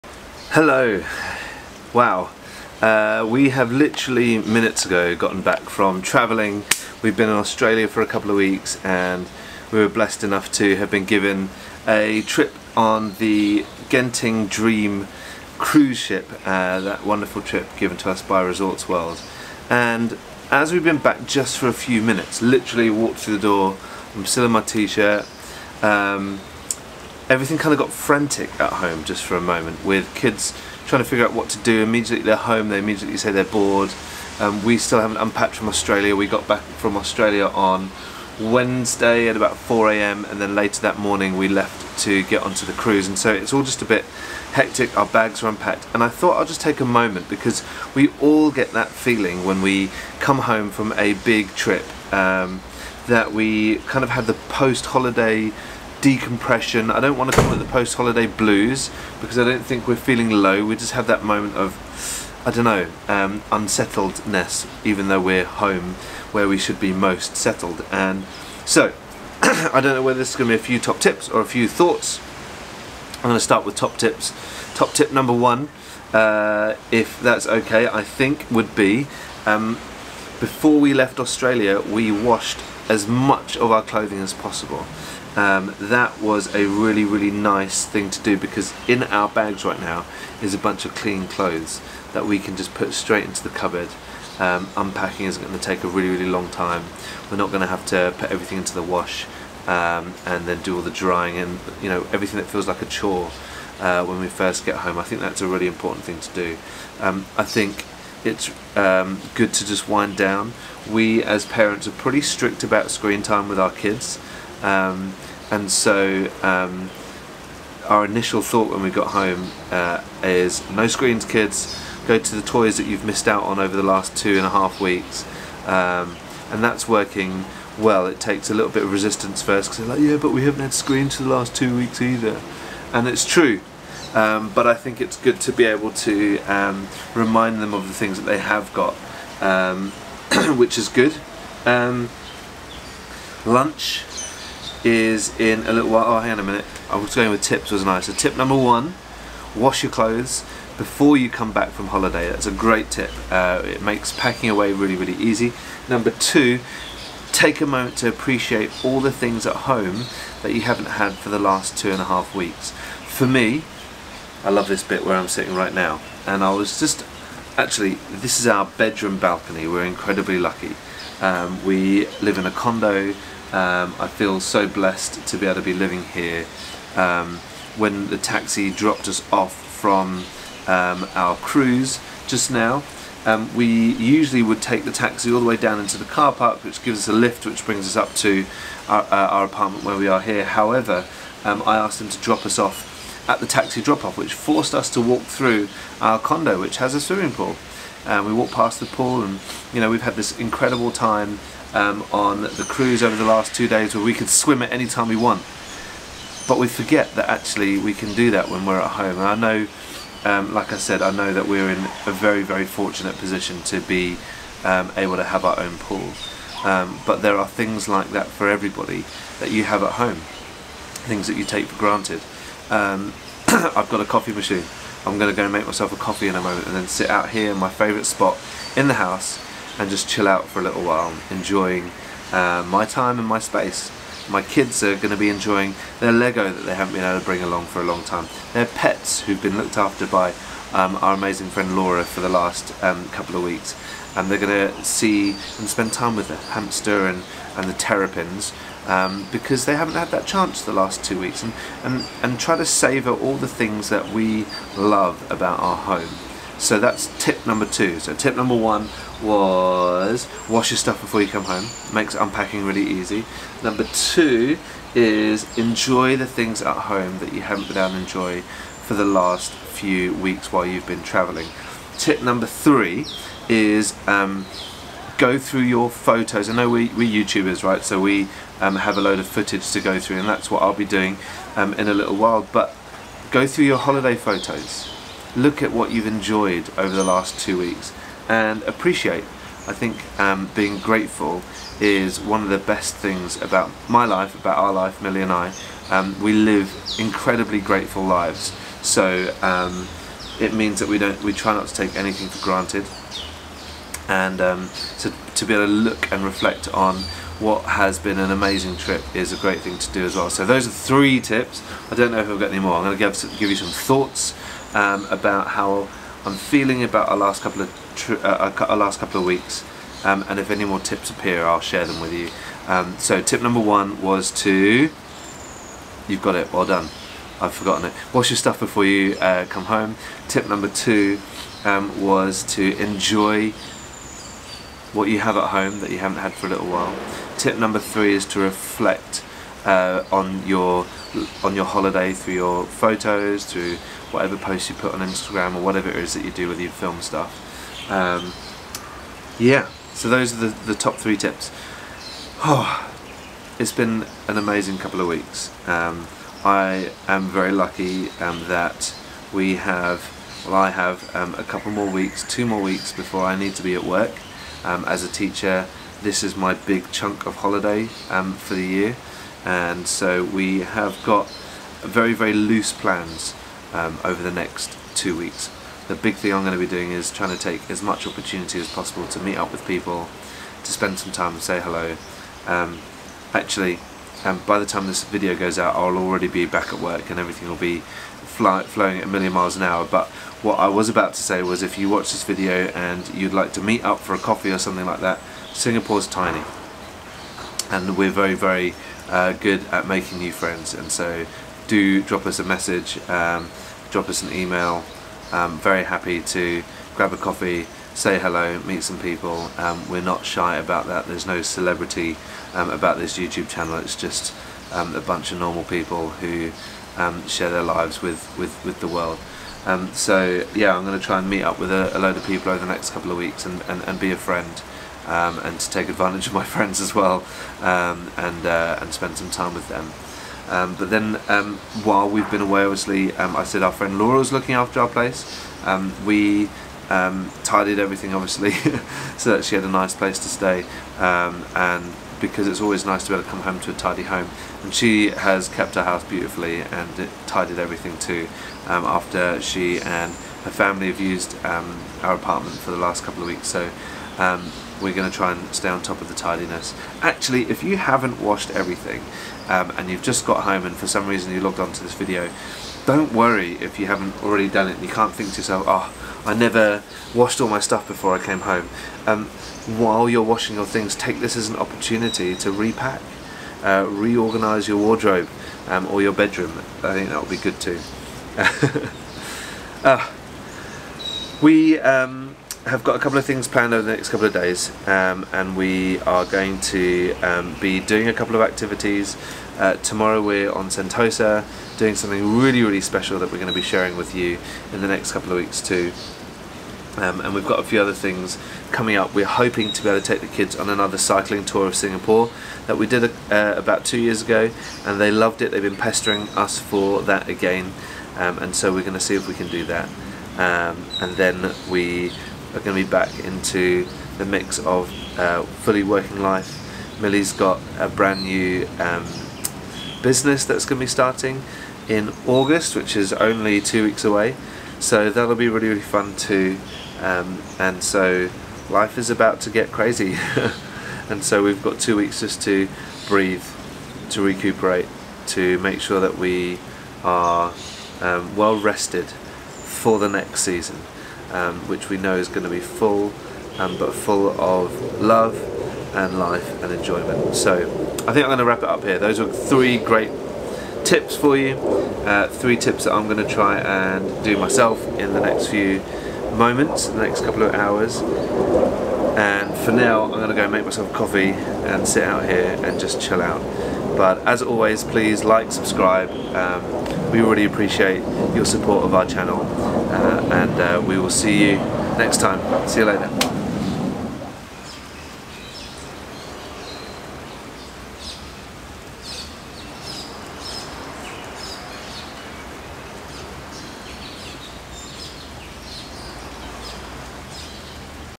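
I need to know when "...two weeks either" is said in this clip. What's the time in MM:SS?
02:11.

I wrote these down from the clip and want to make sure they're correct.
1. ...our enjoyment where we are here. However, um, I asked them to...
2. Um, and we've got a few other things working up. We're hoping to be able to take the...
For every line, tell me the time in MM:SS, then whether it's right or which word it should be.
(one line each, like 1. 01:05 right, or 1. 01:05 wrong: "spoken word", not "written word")
1. 03:09 wrong: "apartment", not "enjoyment"
2. 08:16 wrong: "coming", not "working".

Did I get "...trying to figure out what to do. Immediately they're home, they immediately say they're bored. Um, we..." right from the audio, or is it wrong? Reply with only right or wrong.
right.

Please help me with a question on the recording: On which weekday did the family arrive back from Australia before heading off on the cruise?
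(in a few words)
Wednesday.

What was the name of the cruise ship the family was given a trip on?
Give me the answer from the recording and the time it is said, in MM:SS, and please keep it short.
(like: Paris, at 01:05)
Genting Dream, at 00:13.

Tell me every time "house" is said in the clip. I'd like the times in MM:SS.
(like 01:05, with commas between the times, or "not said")
03:48, 07:25.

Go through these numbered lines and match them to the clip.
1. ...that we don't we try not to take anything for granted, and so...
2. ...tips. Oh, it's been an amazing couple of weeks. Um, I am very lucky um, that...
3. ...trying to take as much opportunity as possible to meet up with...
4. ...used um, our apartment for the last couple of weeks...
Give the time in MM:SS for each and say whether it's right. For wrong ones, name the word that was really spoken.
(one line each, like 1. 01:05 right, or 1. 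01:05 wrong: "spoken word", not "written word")
1. 05:00 right
2. 05:51 right
3. 06:17 right
4. 07:30 right.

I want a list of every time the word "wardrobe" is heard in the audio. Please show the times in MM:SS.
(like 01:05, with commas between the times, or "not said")
07:54.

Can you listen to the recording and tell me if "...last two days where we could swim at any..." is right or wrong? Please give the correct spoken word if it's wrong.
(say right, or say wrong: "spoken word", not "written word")
right.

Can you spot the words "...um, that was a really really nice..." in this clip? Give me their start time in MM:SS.
01:25.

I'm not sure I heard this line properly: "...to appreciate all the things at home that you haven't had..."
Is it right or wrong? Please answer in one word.
right.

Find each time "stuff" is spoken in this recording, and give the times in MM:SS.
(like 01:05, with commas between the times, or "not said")
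04:20, 05:28, 05:47, 07:47.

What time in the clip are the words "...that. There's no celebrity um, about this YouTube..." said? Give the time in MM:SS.
06:50.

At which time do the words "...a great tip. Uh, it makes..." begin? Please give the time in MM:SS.
02:32.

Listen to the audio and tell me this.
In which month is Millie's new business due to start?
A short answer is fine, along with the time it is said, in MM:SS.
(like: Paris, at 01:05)
August, at 08:42.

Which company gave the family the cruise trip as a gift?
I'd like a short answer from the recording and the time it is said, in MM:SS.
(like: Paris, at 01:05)
Resorts World, at 00:18.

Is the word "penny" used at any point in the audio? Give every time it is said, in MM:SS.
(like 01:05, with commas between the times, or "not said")
not said.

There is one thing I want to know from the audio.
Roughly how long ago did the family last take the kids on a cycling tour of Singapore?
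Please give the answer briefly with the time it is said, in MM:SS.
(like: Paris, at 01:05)
About 2 years, at 08:23.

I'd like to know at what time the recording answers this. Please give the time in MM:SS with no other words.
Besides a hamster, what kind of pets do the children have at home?
04:07.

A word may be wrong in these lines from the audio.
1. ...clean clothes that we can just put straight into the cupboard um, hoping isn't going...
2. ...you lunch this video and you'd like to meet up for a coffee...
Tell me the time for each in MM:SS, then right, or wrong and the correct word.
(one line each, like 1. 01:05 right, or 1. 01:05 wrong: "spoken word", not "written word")
1. 01:30 wrong: "unpacking", not "hoping"
2. 06:31 wrong: "watch", not "lunch".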